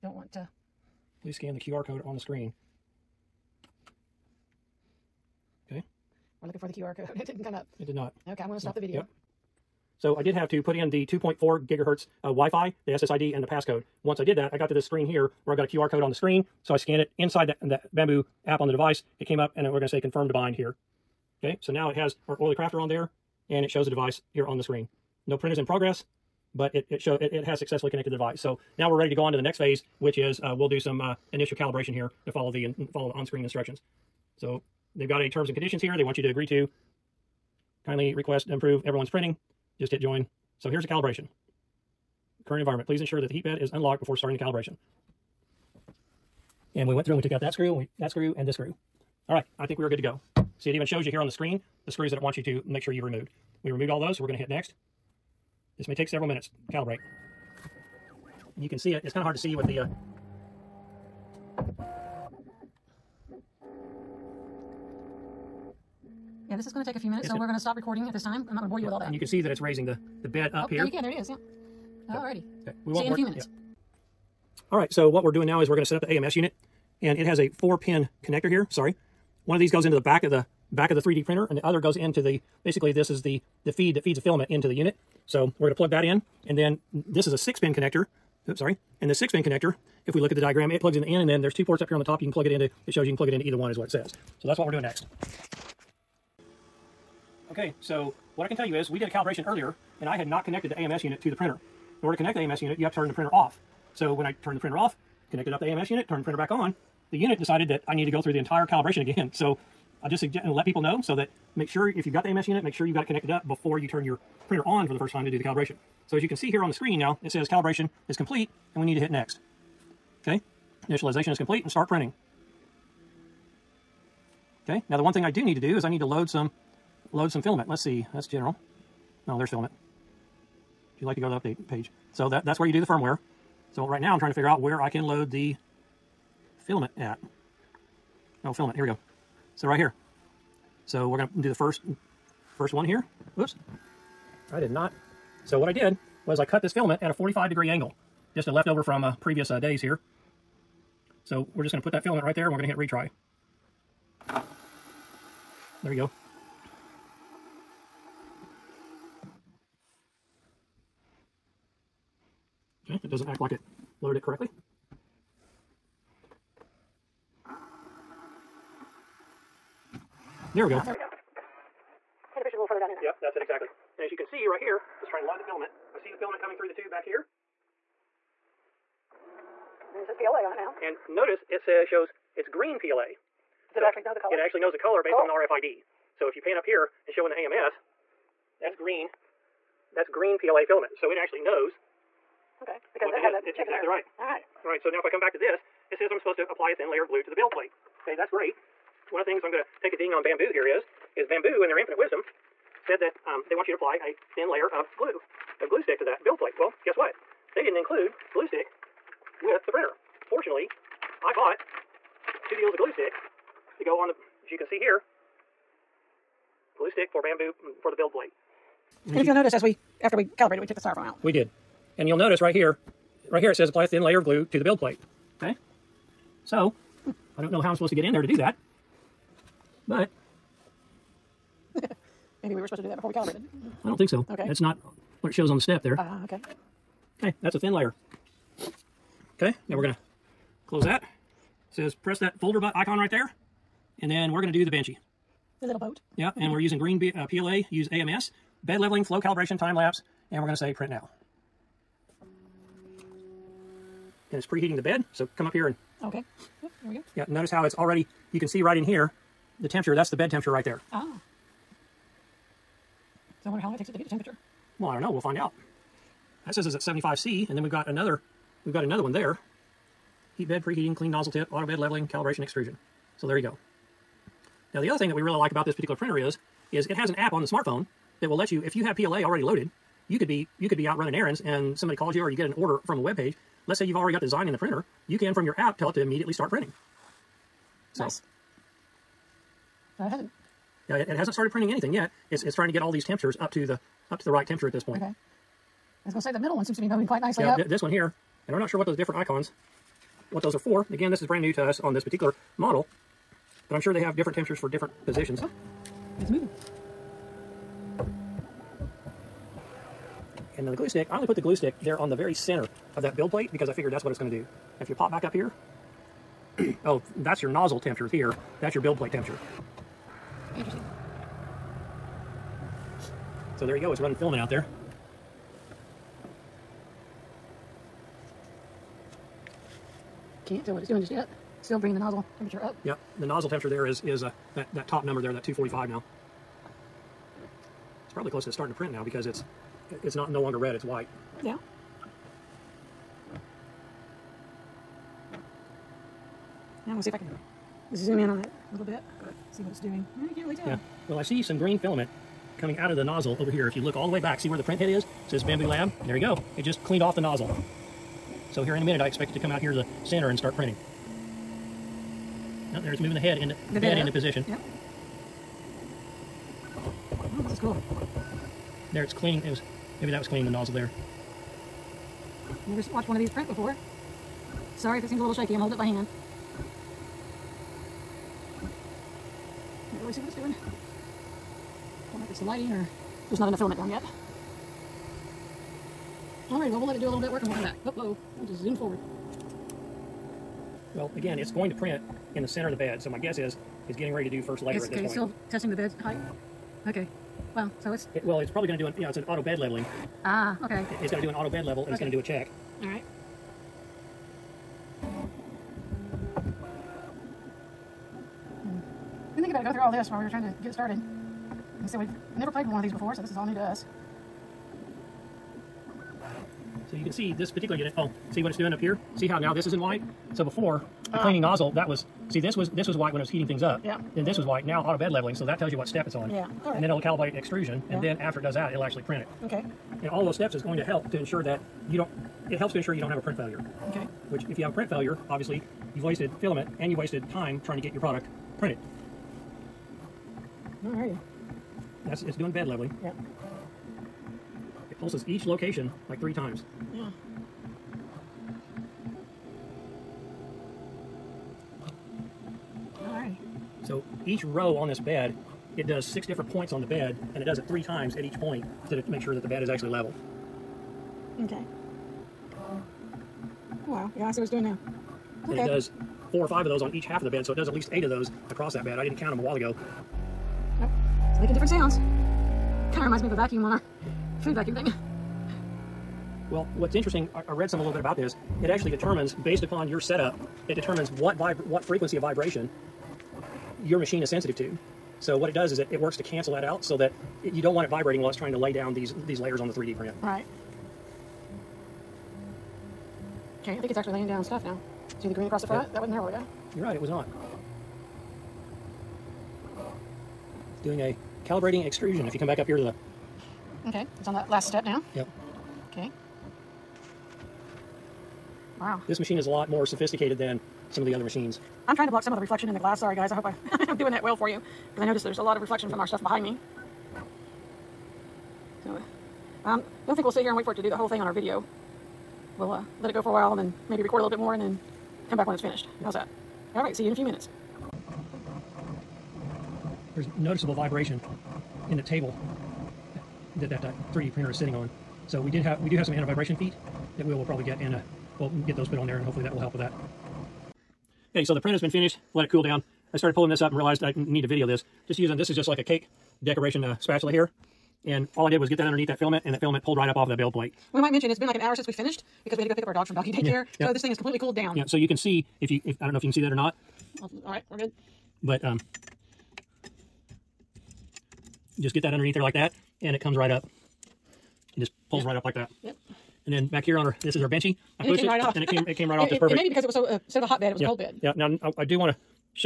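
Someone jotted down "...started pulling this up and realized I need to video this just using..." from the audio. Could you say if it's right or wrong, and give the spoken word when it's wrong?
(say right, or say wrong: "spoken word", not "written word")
right.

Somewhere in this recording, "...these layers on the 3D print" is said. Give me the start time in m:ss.
8:09.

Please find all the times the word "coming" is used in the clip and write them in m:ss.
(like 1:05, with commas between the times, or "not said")
2:56, 5:52.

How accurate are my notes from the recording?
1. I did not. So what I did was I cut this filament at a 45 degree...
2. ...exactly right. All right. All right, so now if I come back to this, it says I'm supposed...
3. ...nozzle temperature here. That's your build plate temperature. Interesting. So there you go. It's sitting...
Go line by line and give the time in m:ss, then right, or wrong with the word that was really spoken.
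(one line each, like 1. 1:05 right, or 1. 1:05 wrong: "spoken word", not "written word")
1. 2:24 right
2. 3:13 right
3. 5:17 wrong: "running", not "sitting".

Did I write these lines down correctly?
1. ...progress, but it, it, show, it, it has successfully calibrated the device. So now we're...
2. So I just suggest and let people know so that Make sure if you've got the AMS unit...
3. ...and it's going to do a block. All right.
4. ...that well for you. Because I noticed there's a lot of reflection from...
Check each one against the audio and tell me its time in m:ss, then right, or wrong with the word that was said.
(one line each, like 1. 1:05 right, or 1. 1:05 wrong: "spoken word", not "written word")
1. 0:25 wrong: "connected", not "calibrated"
2. 1:49 right
3. 6:41 wrong: "check", not "block"
4. 8:34 right.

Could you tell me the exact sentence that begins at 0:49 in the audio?
All right, I think we are good to go.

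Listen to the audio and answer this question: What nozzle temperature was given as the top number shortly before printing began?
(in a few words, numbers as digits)
245.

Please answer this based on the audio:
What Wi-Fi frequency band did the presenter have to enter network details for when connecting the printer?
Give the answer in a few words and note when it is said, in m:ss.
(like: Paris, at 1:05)
2.4 gigahertz, at 0:11.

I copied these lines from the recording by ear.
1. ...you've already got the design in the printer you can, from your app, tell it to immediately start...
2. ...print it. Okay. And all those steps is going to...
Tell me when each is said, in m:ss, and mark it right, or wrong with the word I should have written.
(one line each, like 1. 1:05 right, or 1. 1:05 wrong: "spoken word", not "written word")
1. 4:43 right
2. 7:09 right.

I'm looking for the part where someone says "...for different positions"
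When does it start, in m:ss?
5:04.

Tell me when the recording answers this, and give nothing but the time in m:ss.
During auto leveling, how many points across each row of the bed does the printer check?
7:36.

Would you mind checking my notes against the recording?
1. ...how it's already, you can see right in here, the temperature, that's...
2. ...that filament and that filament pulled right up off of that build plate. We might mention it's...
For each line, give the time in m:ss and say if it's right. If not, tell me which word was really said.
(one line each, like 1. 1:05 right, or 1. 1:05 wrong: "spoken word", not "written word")
1. 4:17 right
2. 9:09 right.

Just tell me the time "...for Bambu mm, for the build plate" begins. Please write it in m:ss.
3:37.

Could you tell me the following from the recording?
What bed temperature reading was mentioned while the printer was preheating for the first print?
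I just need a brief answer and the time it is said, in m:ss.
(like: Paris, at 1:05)
75C, at 4:26.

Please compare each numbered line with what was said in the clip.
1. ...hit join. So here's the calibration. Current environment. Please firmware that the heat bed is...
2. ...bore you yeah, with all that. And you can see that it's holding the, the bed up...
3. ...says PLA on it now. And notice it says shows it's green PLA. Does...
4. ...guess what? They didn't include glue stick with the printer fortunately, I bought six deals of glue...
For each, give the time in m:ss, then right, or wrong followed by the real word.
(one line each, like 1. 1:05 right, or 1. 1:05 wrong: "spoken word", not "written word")
1. 0:39 wrong: "ensure", not "firmware"
2. 1:08 wrong: "raising", not "holding"
3. 3:00 right
4. 3:26 wrong: "two", not "six".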